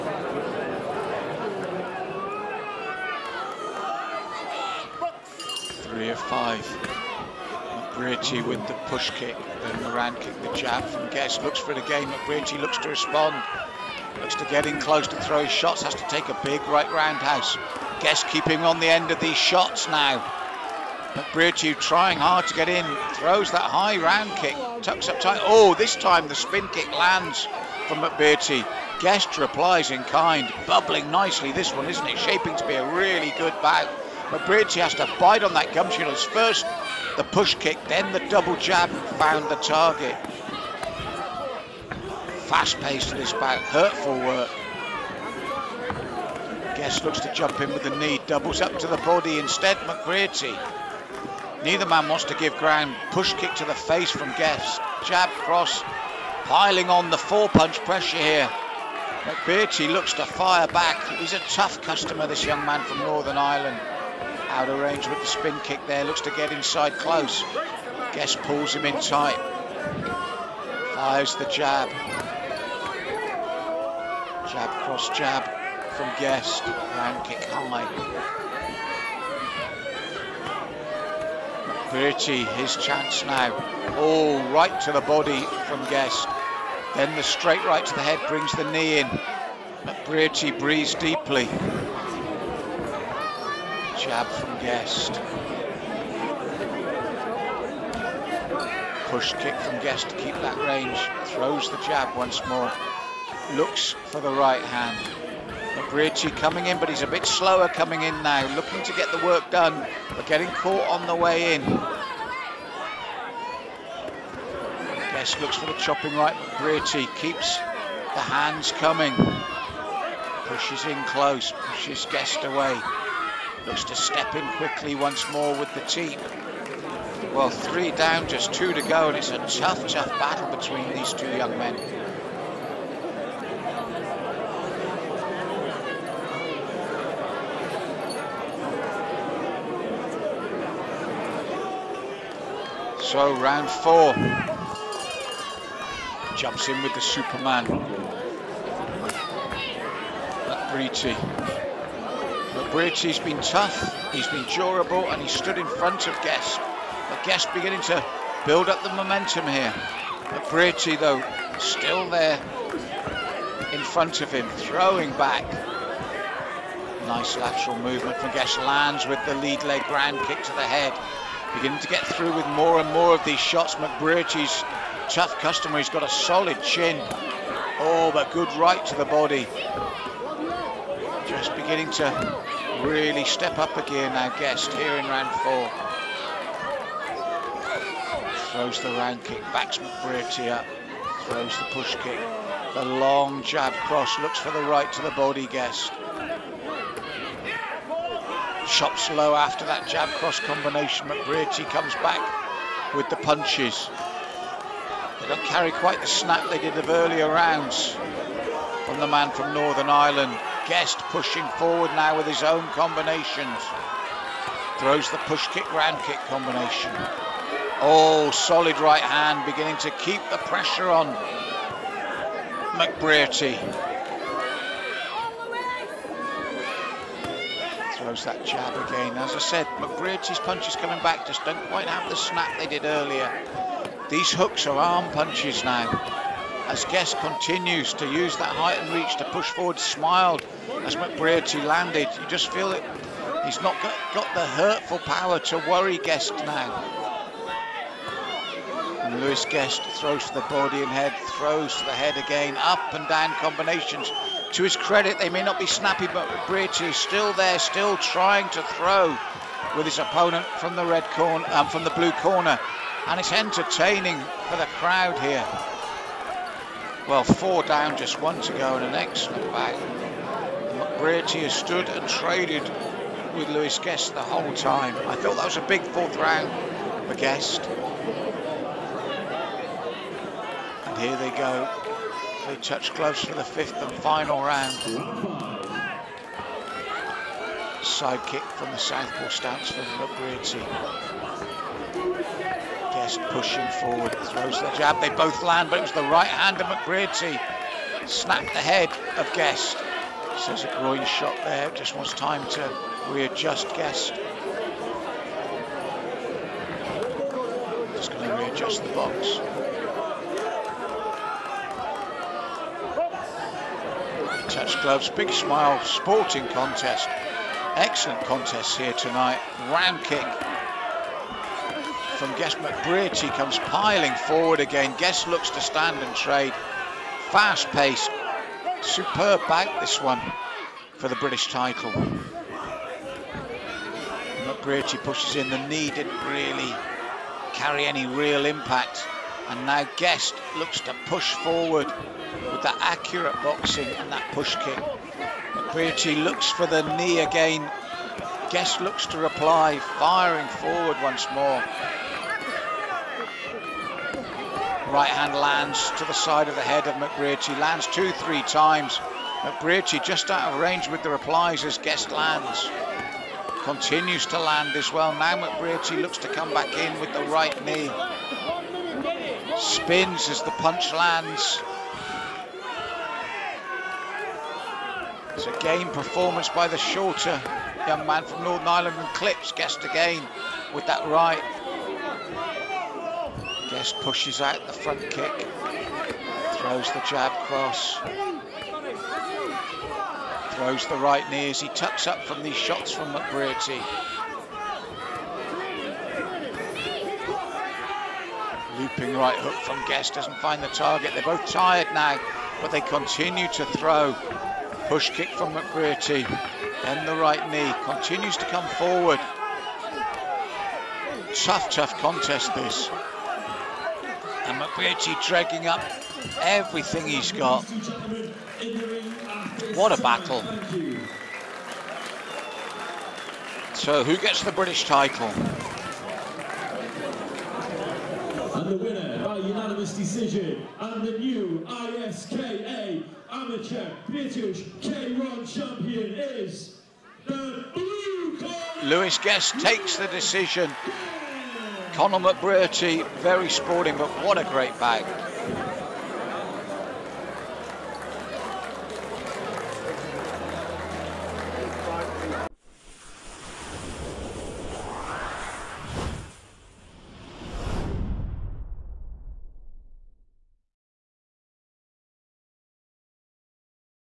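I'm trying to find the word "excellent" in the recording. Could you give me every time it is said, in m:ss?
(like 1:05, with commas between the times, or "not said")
4:28, 5:17.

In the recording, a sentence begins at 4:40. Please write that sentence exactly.
And here they go, Hopefully touch gloves for the fifth and final round.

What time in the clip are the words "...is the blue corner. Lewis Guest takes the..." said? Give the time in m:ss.
7:16.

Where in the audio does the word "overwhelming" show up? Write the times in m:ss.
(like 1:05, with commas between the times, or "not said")
not said.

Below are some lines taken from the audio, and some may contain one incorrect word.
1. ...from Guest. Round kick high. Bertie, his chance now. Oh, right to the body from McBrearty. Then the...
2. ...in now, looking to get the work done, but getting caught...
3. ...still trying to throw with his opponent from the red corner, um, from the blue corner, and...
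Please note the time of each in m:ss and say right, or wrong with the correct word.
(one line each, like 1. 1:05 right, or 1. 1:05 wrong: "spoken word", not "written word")
1. 1:15 wrong: "Guest", not "McBrearty"
2. 1:48 right
3. 4:17 right.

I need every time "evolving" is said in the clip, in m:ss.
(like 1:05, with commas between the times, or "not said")
not said.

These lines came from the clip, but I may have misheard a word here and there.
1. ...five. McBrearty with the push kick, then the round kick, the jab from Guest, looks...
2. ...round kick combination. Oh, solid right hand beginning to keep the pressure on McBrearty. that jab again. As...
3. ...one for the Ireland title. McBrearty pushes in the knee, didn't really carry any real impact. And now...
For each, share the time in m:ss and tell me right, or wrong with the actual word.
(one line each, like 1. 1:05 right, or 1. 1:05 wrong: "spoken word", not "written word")
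1. 0:06 right
2. 3:35 right
3. 5:30 wrong: "British", not "Ireland".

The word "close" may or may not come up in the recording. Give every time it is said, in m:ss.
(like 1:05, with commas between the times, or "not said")
0:14, 1:06, 2:01.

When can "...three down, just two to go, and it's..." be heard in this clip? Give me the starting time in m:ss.
2:07.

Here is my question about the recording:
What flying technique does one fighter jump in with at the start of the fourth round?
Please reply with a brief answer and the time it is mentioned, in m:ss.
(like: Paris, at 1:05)
Superman, at 2:26.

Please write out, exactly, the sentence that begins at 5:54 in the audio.
Right hand lands to the side of the head of McBrearty, lands two, three times.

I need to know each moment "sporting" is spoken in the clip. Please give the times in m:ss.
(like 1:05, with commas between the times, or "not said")
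5:15, 7:23.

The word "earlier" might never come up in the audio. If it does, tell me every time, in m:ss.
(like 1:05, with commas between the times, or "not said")
3:26, 3:52.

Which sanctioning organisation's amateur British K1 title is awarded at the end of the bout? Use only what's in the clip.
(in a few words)
ISKA.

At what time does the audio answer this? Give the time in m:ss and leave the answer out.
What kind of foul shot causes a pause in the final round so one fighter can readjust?
5:00.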